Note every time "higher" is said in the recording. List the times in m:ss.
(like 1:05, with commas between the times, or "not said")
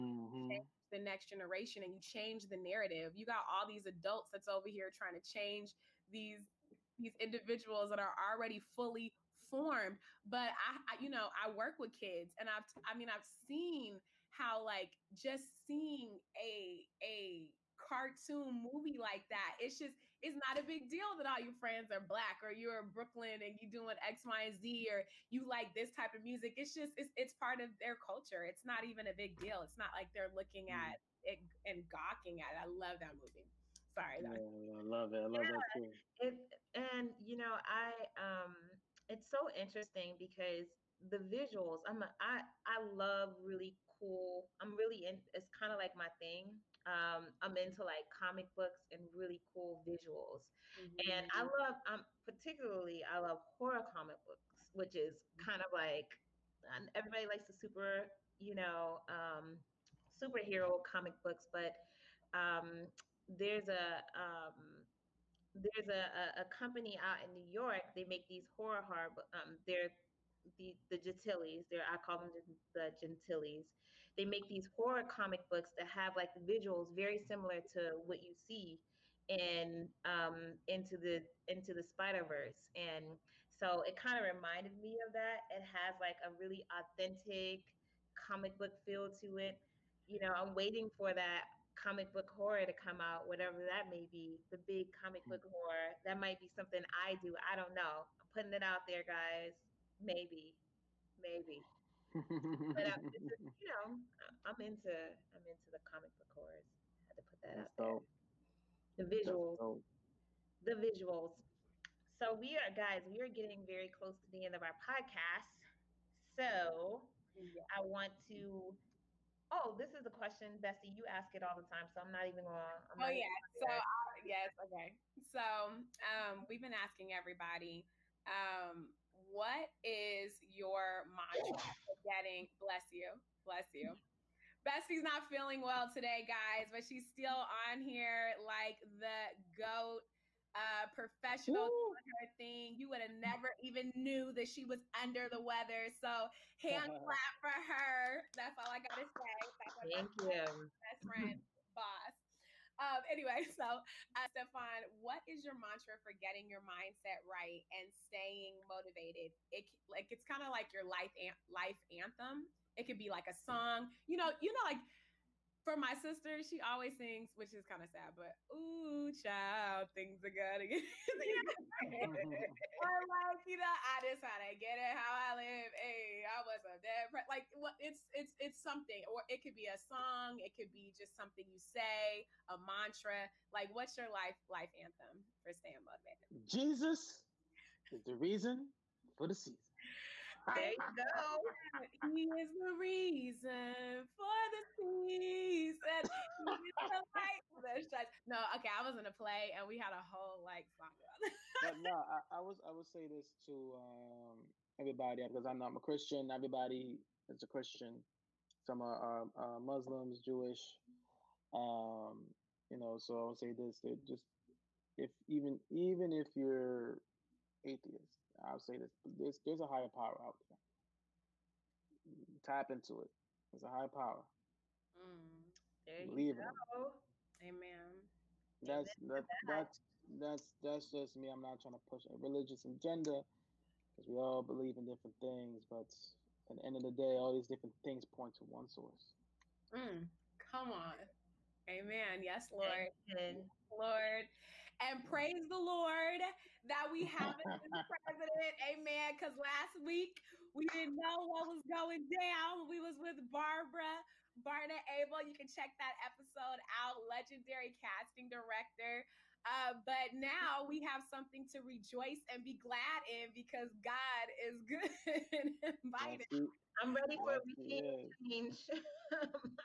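3:39, 3:43.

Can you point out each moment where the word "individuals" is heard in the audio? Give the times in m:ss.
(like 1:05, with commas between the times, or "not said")
0:07.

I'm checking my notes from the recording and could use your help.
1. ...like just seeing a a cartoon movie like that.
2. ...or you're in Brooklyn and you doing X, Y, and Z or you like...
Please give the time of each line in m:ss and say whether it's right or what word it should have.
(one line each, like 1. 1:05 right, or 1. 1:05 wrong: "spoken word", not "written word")
1. 0:14 right
2. 0:22 right.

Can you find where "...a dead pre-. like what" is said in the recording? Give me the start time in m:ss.
2:56.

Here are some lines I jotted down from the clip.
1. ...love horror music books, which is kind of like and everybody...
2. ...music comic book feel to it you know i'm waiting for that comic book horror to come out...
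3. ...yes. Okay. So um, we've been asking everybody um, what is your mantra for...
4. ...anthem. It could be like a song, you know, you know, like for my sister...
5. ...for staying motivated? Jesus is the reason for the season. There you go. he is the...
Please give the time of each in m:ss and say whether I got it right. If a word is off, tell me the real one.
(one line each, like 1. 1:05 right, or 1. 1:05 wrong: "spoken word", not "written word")
1. 0:53 wrong: "comic", not "music"
2. 1:26 wrong: "authentic", not "music"
3. 2:04 right
4. 2:41 right
5. 3:05 right.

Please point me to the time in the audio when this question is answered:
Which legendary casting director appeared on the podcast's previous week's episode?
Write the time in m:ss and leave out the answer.
4:13.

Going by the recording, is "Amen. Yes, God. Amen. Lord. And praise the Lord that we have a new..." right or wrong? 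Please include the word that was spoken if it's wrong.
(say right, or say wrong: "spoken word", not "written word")
wrong: "Lord", not "God".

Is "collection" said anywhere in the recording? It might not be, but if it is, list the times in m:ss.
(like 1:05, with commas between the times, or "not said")
not said.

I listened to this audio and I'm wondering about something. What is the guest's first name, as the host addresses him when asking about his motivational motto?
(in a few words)
Stefon.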